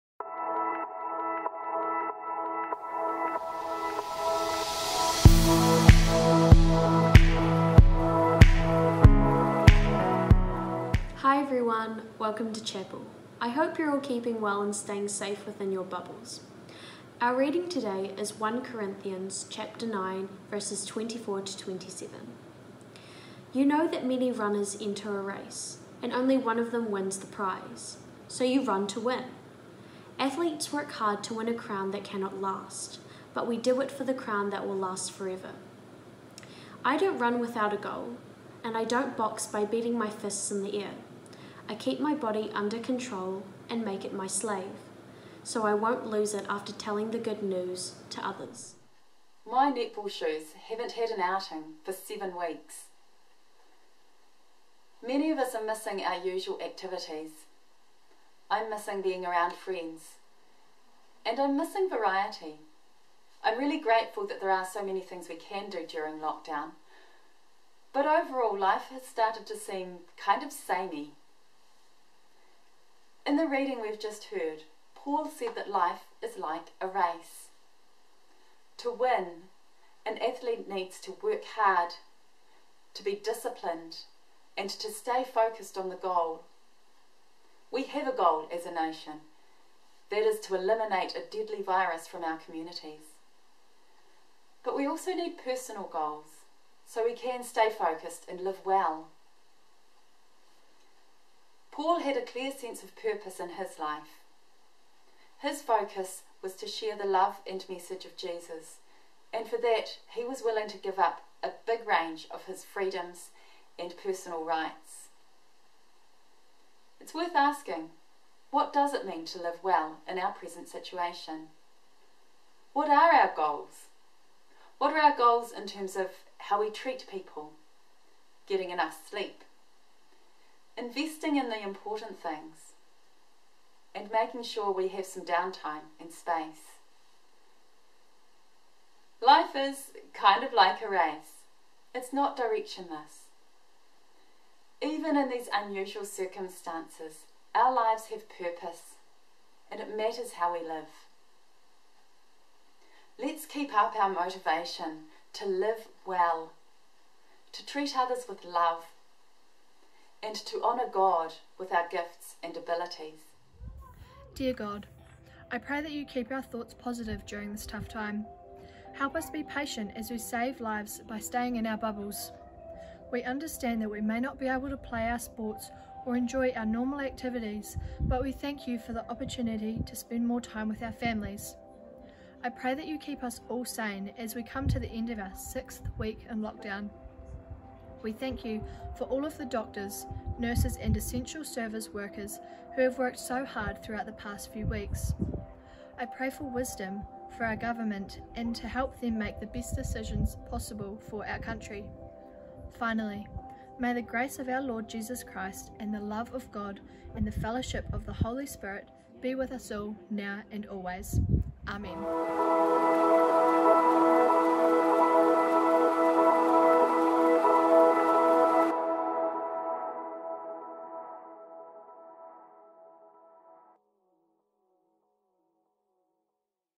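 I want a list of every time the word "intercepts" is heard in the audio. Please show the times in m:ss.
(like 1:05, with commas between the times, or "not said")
not said.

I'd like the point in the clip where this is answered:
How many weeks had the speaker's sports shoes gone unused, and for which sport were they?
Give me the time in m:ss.
0:49.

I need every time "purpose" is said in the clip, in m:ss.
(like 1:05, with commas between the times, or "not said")
1:42, 2:28.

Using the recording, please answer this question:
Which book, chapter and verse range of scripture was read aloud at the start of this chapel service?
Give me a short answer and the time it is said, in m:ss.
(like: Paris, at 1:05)
1 Corinthians 9:24-27, at 0:18.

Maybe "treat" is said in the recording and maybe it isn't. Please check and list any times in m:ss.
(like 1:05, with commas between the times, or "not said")
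2:06, 2:37.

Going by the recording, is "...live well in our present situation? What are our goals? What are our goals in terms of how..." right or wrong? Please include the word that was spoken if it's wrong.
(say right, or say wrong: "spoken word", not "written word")
right.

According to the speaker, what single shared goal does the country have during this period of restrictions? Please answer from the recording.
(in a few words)
Eliminate a deadly virus.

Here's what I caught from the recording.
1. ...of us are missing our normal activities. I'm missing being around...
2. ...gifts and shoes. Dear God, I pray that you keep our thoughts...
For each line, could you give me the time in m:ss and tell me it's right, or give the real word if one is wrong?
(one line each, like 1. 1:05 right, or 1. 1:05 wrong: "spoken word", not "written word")
1. 0:55 wrong: "usual", not "normal"
2. 2:41 wrong: "abilities", not "shoes".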